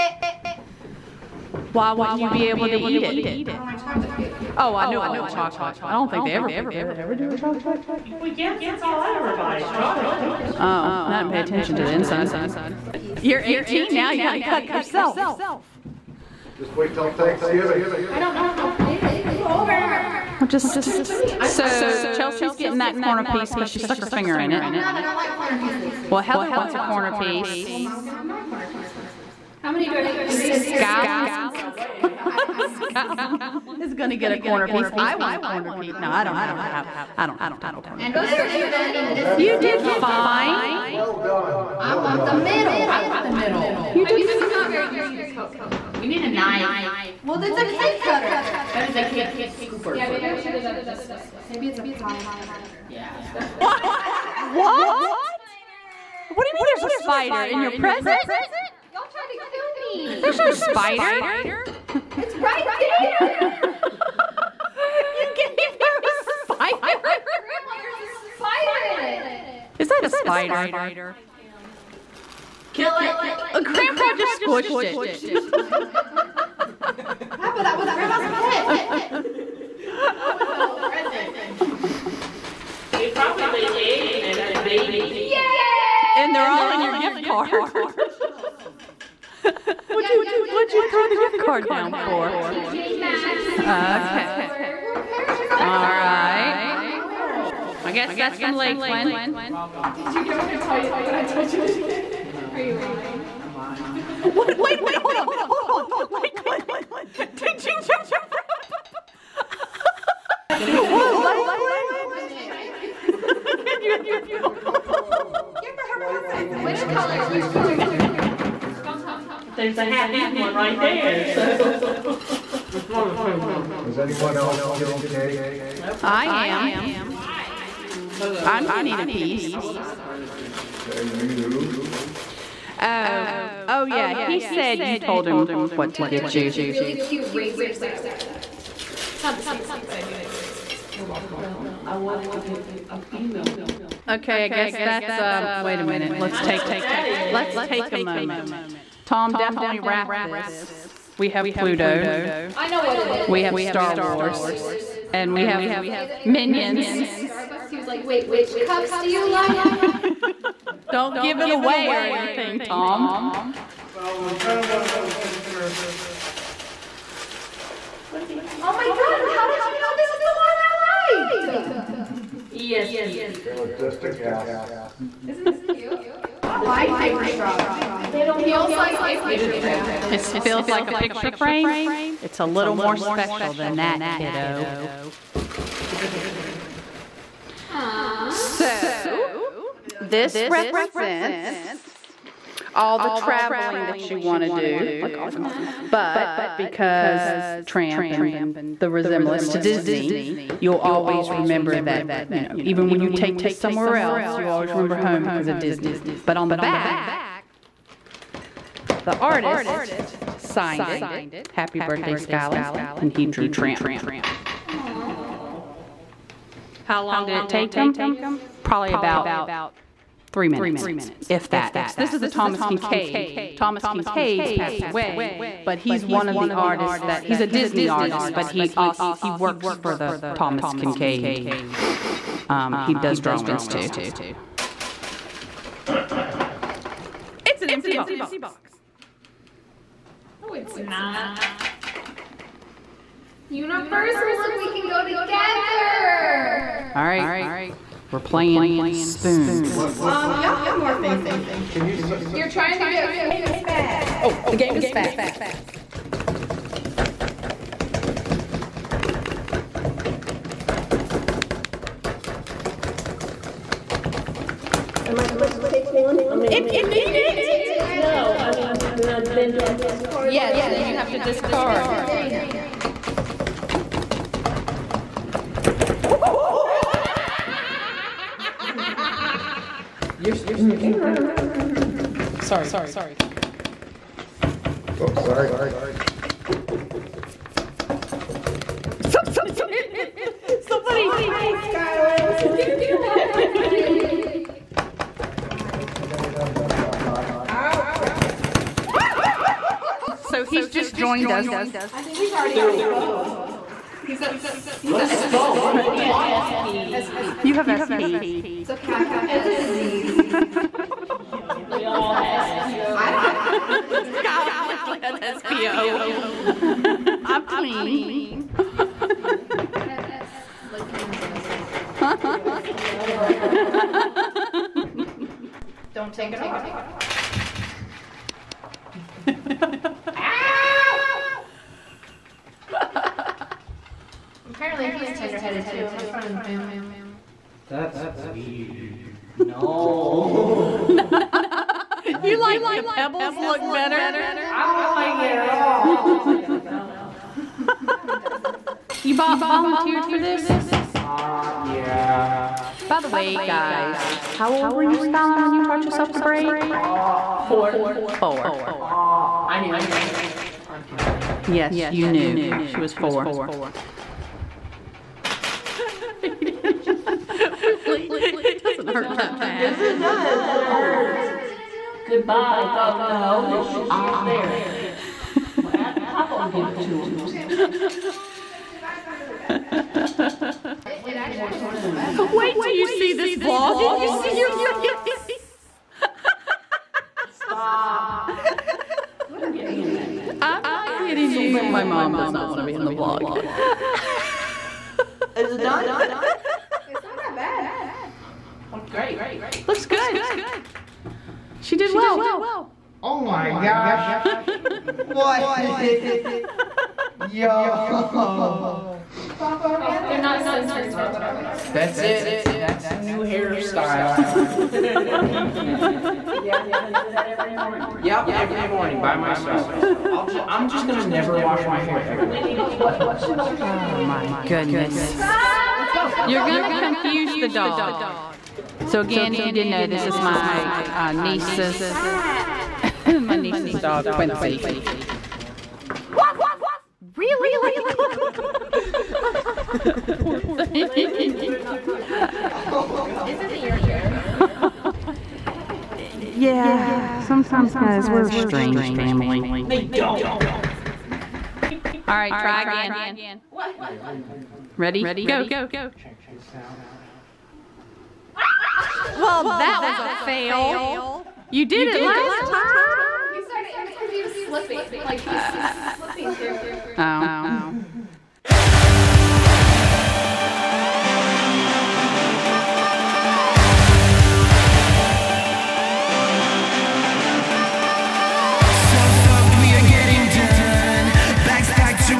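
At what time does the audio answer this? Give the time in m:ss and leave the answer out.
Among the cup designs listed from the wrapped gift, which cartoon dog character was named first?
2:31.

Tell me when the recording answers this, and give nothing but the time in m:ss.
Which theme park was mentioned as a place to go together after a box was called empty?
4:03.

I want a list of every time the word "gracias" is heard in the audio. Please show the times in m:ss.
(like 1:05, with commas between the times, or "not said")
not said.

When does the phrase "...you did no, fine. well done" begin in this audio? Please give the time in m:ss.
0:39.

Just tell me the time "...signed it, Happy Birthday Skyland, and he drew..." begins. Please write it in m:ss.
3:30.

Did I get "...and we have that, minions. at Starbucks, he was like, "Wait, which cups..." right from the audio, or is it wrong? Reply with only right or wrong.
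right.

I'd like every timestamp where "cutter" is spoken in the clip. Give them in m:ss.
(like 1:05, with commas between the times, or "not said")
0:47, 0:52.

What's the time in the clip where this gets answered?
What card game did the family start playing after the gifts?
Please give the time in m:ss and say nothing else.
4:08.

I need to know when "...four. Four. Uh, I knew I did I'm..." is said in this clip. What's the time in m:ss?
5:57.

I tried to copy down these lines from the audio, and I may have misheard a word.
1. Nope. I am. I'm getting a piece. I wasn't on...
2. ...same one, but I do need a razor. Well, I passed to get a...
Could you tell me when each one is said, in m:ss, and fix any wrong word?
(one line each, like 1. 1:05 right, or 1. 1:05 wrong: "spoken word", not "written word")
1. 2:05 right
2. 2:19 wrong: "wanted", not "passed".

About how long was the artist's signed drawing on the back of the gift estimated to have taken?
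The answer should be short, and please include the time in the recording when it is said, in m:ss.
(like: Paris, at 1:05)
about 3 minutes, at 3:38.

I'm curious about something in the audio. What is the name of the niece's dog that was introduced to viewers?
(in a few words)
Quincy.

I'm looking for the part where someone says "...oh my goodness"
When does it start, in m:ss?
7:03.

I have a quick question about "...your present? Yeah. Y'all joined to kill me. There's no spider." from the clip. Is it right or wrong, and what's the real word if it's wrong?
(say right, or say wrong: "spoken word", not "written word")
wrong: "tried", not "joined".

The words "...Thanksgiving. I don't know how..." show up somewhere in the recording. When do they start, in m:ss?
0:17.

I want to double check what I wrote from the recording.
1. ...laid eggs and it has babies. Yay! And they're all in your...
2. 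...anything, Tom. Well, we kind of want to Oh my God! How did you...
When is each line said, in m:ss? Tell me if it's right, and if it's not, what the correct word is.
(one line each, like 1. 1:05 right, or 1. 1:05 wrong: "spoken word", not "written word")
1. 1:23 right
2. 2:42 right.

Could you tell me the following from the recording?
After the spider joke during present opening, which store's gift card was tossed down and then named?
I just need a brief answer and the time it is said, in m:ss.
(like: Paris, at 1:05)
TJ Maxx, at 1:32.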